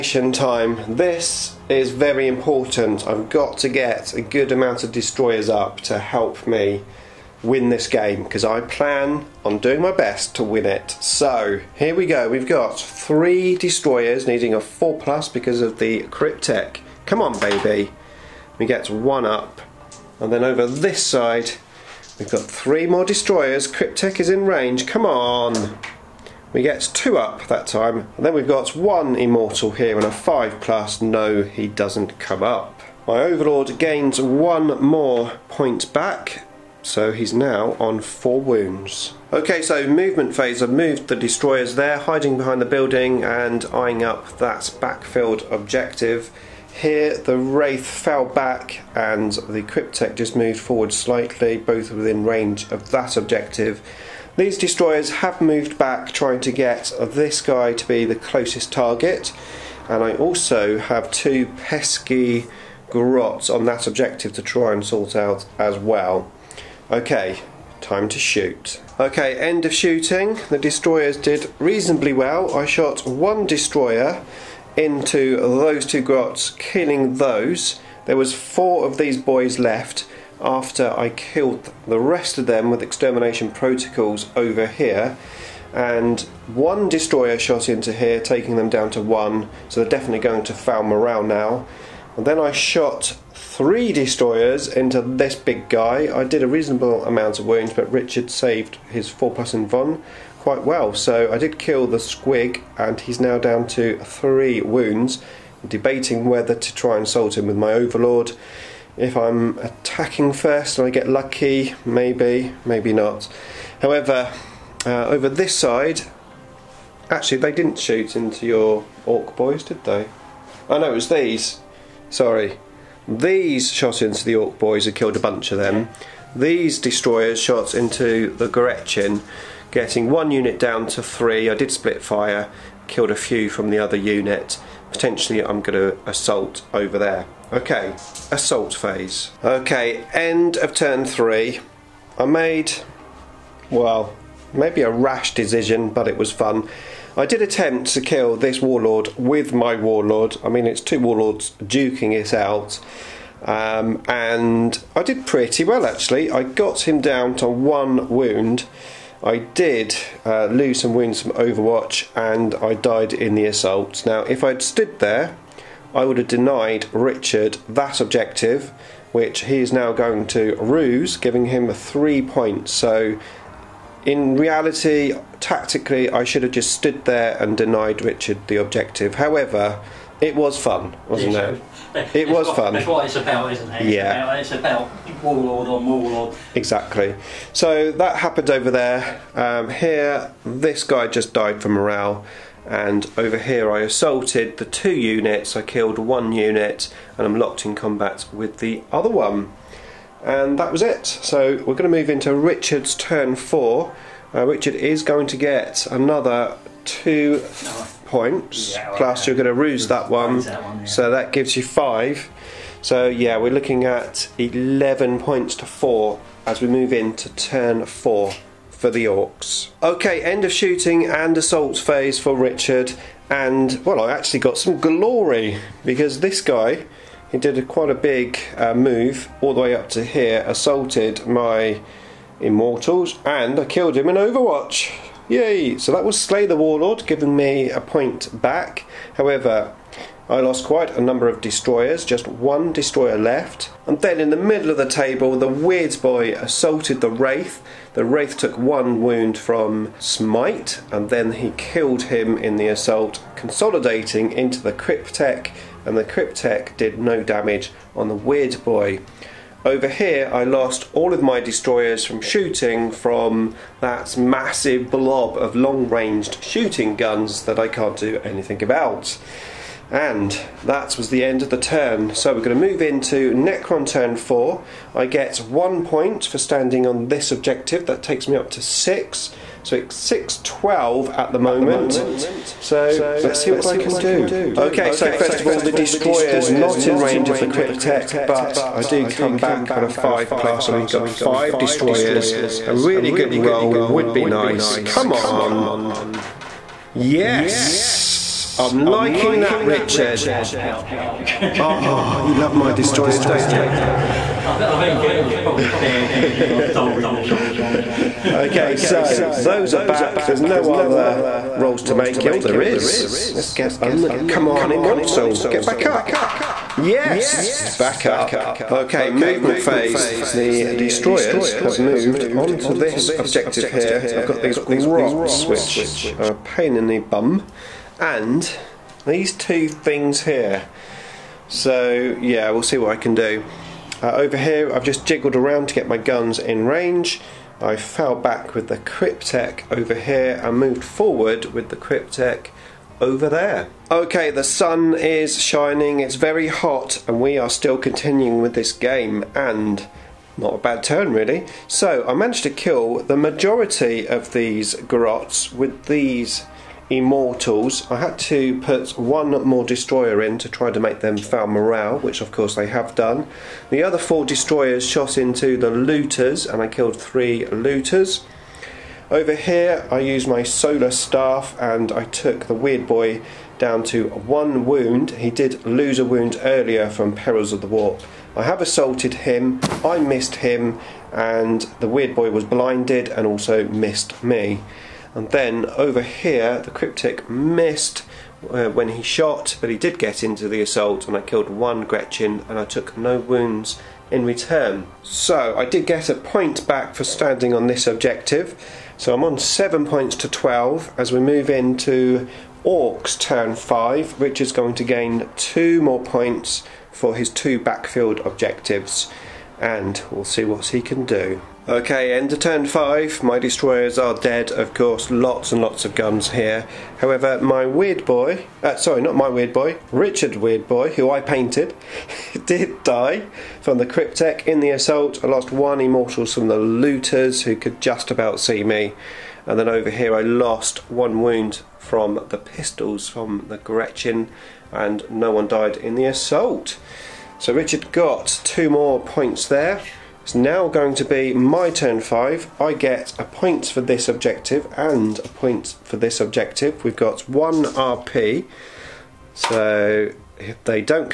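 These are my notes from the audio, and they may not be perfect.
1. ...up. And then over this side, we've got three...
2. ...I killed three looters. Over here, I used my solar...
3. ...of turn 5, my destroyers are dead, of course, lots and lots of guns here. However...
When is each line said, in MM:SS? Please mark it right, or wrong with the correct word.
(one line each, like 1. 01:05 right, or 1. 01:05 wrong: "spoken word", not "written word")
1. 00:19 right
2. 06:06 right
3. 06:52 right.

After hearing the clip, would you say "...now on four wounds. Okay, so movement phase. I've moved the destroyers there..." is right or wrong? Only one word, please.
right.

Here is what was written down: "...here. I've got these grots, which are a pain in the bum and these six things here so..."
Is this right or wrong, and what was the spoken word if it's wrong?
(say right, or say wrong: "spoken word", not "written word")
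wrong: "two", not "six".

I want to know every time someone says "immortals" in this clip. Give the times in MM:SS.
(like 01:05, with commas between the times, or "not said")
00:29, 03:52, 05:14, 05:56, 07:05.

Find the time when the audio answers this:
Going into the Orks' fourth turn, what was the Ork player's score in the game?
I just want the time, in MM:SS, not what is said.
03:34.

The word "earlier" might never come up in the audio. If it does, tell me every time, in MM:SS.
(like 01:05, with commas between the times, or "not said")
06:16.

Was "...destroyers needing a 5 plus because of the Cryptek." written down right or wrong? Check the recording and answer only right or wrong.
wrong.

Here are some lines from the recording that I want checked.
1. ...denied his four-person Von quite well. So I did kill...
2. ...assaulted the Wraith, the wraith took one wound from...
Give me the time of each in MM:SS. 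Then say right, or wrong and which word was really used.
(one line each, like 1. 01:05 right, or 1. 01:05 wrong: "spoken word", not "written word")
1. 01:38 wrong: "saved", not "denied"
2. 04:06 right.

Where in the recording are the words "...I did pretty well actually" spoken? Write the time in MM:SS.
02:34.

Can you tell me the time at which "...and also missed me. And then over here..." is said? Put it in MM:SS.
06:23.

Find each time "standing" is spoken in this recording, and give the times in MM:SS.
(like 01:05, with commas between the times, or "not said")
04:36, 06:37.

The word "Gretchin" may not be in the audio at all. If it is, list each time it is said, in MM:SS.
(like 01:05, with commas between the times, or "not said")
02:08, 06:31, 07:13.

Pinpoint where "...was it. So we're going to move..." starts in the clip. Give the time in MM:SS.
03:20.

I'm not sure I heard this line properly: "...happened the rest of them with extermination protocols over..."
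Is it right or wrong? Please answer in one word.
wrong.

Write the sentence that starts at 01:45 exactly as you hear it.
I'm debating whether to try and salt him with my overlord.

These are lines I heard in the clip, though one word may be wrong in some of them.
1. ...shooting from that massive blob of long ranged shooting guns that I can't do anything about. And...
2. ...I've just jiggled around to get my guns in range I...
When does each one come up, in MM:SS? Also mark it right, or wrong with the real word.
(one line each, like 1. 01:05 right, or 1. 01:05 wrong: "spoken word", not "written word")
1. 04:22 right
2. 05:34 right.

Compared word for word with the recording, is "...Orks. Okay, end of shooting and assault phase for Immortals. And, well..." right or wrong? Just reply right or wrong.
wrong.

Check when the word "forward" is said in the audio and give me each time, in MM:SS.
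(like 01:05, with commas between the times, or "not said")
00:50, 05:40.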